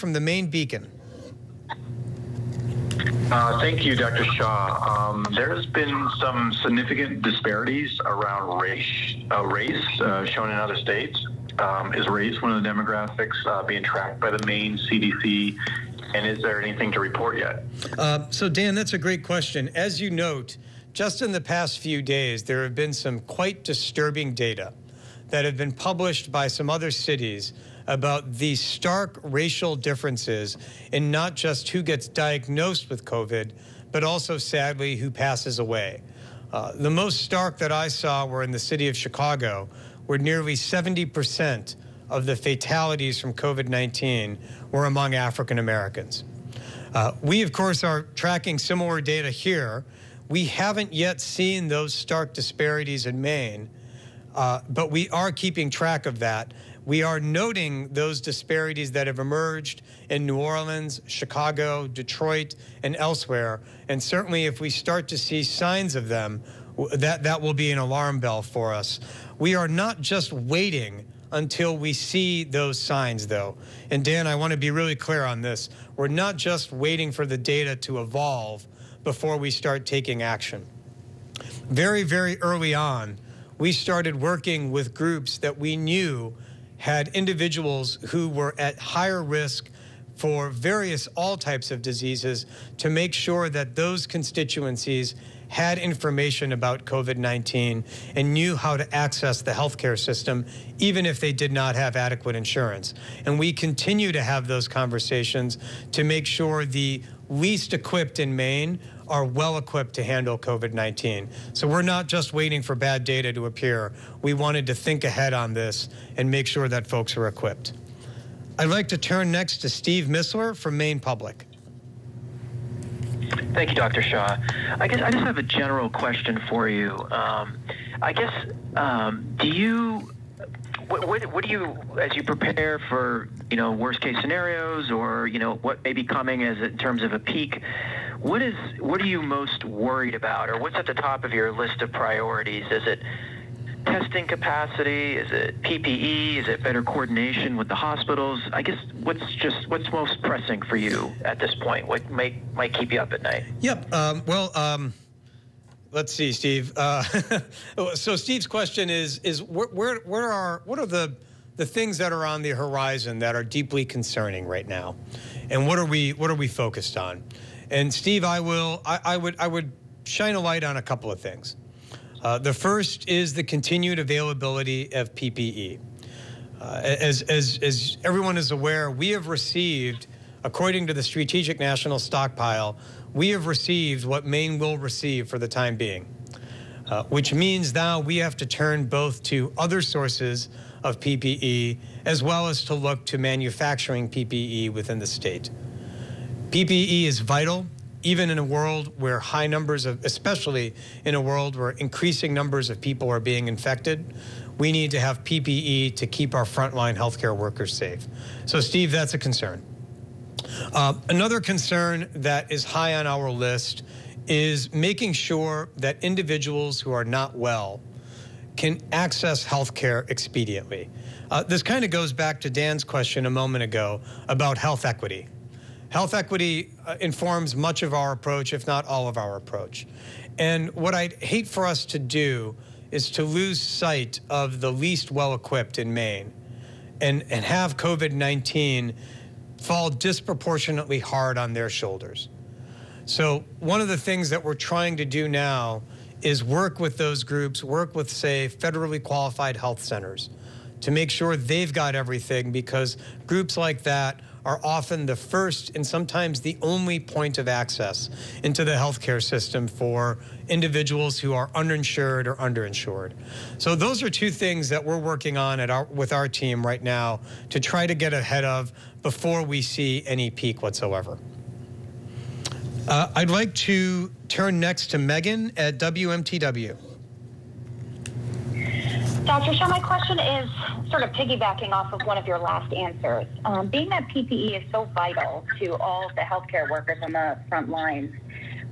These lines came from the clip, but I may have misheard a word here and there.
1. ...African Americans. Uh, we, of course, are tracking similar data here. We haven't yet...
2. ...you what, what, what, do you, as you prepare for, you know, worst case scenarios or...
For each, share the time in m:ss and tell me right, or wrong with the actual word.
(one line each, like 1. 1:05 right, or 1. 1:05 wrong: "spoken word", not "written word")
1. 0:45 right
2. 2:09 right.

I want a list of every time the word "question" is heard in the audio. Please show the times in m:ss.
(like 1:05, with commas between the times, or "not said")
0:19, 2:05, 2:38, 3:42, 4:39.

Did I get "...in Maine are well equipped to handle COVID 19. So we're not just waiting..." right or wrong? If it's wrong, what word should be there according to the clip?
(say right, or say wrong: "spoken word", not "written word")
right.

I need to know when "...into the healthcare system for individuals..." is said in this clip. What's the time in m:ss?
4:18.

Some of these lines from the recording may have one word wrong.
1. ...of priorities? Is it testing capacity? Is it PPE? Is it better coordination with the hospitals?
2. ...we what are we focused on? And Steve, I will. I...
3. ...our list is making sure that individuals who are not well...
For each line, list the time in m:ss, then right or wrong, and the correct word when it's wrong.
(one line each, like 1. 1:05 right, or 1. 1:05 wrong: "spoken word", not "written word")
1. 2:21 right
2. 2:45 right
3. 3:33 right.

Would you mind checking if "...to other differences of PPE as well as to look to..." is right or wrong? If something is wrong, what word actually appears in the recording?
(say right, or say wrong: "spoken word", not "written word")
wrong: "sources", not "differences".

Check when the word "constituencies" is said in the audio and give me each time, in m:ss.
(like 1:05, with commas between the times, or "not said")
1:34.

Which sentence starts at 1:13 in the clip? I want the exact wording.
And Dan, I want to be really clear on this.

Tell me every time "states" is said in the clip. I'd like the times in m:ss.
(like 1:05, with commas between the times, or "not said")
0:10, 3:15.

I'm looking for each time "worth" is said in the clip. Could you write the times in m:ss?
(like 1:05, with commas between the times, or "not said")
not said.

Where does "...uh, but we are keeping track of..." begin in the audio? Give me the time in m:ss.
0:54.